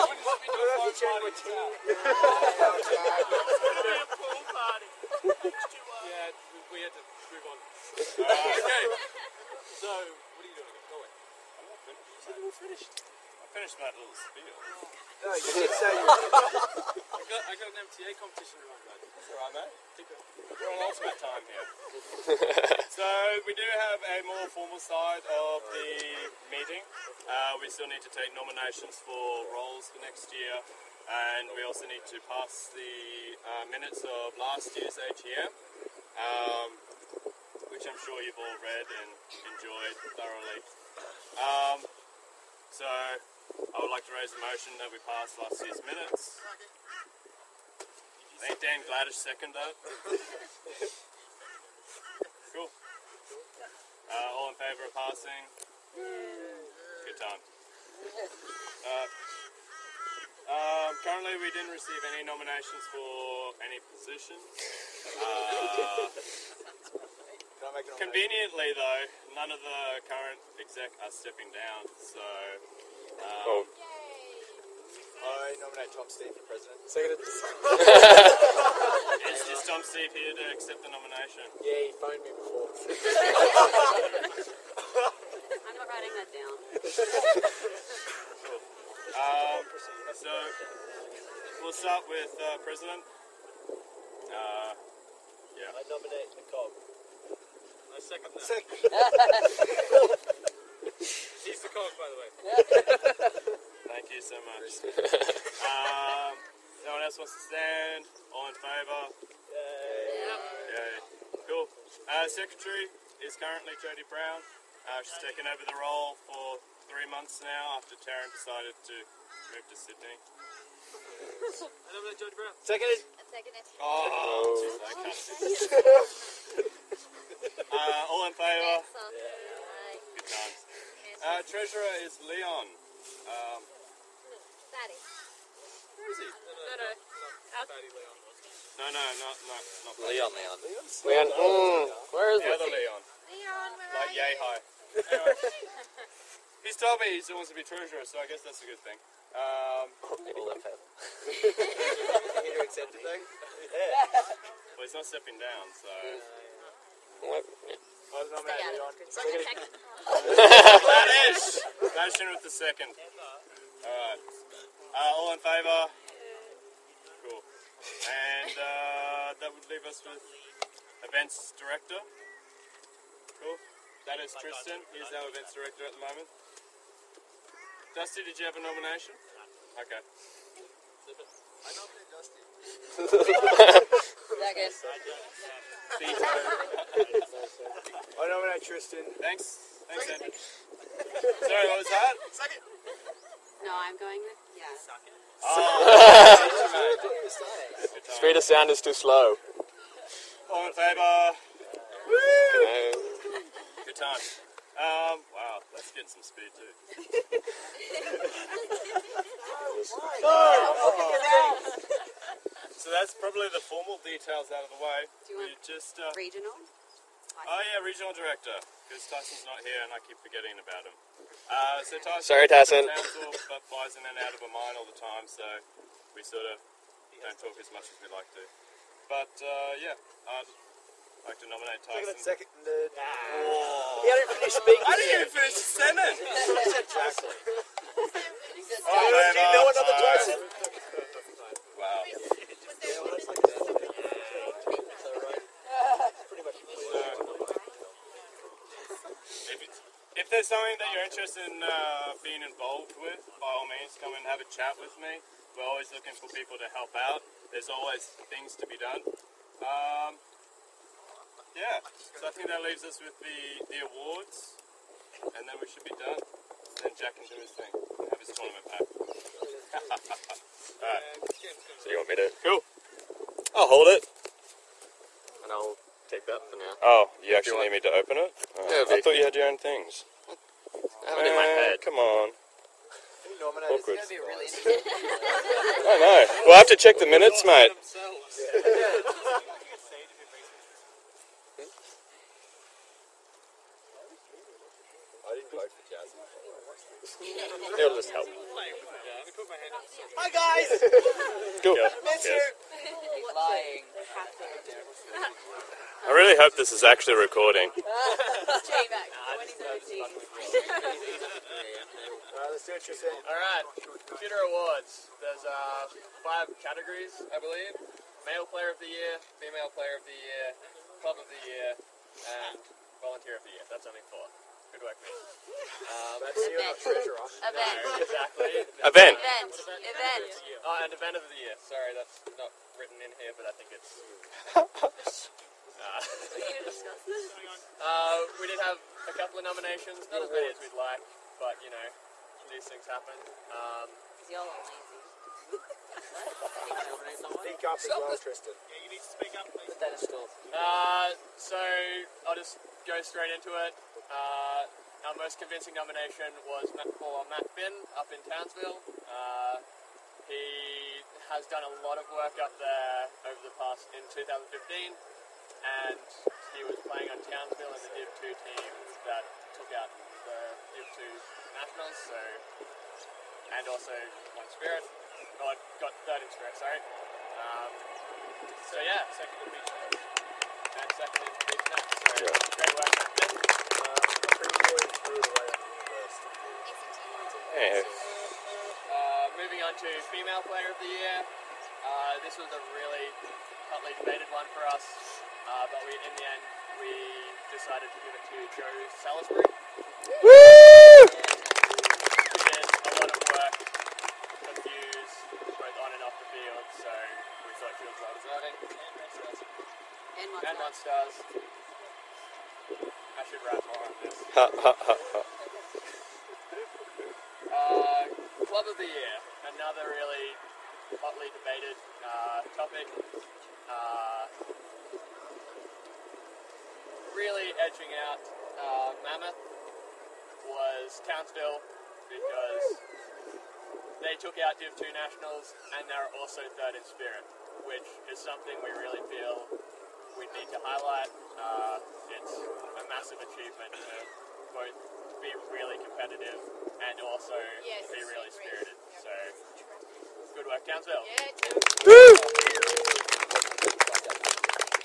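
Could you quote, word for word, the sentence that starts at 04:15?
We're always looking for people to help out.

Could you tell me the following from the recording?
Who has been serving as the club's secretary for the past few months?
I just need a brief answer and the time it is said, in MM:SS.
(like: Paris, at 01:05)
Jodie Brown, at 01:53.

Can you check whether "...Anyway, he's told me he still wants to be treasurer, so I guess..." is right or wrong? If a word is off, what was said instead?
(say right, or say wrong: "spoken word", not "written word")
right.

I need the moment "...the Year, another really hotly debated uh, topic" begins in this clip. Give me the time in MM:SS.
06:58.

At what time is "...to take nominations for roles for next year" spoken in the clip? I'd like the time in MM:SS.
00:28.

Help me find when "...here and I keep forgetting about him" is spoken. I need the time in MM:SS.
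03:39.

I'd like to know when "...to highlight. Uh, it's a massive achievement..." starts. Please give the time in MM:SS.
07:20.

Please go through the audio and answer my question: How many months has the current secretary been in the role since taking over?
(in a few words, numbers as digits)
3.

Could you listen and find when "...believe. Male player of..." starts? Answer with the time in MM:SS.
05:17.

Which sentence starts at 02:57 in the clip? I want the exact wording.
Dusty, did you have a nomination?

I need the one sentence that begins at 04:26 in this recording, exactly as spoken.
Then Jack can do his thing and have his tournament back.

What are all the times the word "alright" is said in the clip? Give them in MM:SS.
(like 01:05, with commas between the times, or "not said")
00:19, 02:42, 04:30.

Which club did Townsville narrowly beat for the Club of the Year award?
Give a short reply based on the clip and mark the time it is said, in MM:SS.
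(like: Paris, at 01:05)
Mammoth, at 07:09.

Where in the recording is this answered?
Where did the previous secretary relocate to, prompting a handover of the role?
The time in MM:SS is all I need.
01:59.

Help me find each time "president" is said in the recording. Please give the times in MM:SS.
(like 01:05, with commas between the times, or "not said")
01:16, 01:32.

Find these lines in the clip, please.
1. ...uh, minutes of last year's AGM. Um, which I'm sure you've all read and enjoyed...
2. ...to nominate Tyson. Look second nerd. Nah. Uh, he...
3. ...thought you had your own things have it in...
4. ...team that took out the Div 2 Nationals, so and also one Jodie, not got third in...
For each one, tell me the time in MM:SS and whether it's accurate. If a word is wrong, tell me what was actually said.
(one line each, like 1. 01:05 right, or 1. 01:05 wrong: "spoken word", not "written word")
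1. 00:33 right
2. 03:51 right
3. 04:38 right
4. 06:08 wrong: "Spirit", not "Jodie".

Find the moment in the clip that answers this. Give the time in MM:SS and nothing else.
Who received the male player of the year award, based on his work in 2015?
05:57.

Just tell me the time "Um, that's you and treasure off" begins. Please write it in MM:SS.
05:25.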